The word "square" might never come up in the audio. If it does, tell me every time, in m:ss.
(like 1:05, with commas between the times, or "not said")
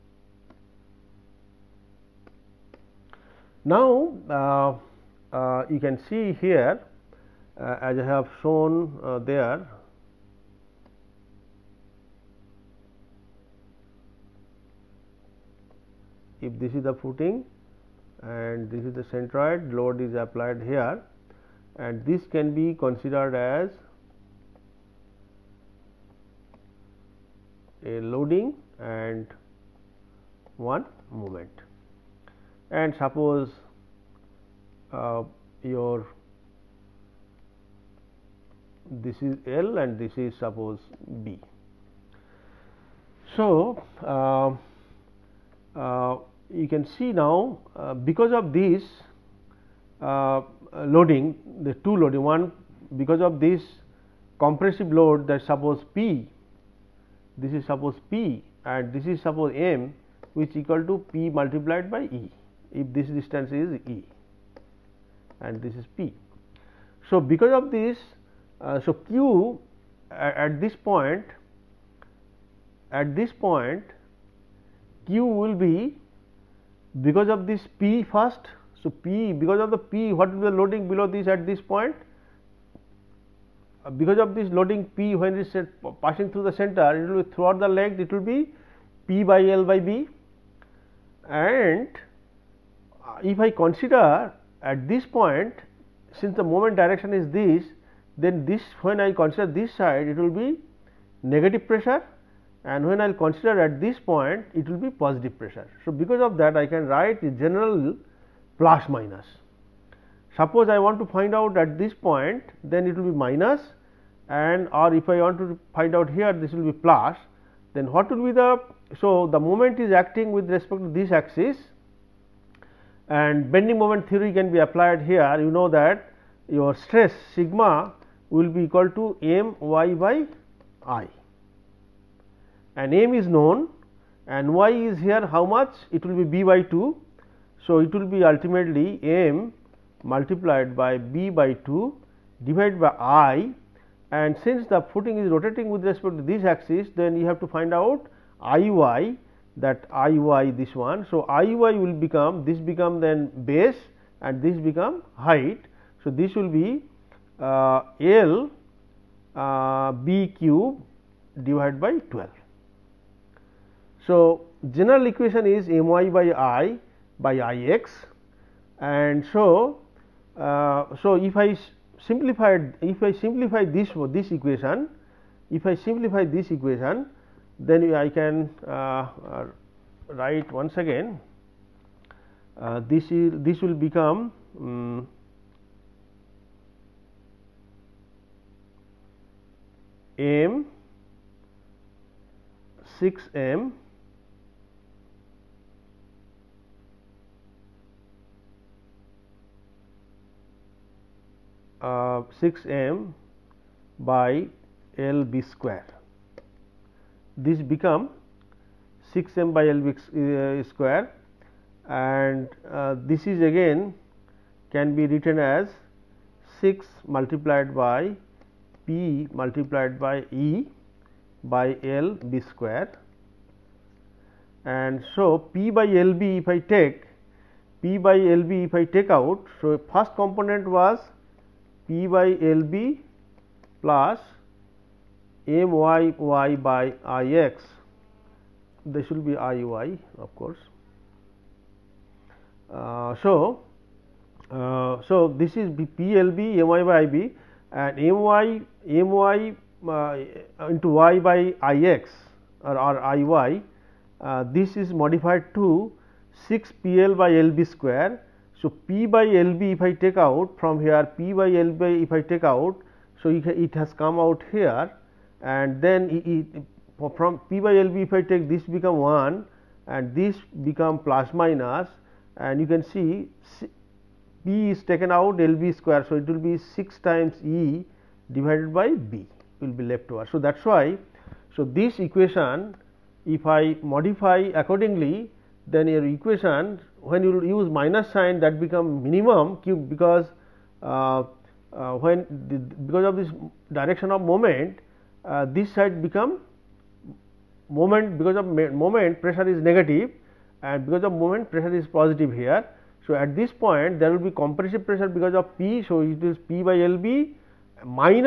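3:25, 3:30, 3:42, 4:17, 4:35.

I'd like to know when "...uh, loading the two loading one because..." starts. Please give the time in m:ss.
0:50.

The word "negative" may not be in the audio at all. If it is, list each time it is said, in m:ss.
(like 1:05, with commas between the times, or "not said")
1:41, 4:59.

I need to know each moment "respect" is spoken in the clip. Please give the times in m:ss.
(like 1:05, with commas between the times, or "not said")
2:00, 2:25.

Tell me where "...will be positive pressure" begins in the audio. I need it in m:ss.
1:44.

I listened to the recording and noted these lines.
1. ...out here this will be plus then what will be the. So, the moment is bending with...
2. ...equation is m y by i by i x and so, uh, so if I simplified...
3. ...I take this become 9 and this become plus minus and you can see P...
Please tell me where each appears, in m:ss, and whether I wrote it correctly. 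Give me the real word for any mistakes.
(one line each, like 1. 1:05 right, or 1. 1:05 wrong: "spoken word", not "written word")
1. 1:55 wrong: "acting", not "bending"
2. 2:45 right
3. 4:28 wrong: "1", not "9".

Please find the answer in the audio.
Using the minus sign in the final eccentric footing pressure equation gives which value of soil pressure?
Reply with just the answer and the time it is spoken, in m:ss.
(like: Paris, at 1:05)
minimum q, at 4:49.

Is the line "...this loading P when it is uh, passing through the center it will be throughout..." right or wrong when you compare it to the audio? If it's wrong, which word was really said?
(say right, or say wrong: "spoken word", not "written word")
right.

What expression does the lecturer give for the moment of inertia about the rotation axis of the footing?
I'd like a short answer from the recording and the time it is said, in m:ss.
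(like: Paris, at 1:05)
L b^3/12, at 2:38.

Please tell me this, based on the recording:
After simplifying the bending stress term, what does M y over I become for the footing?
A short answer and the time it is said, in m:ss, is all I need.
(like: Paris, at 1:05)
6M/(L b^2), at 3:29.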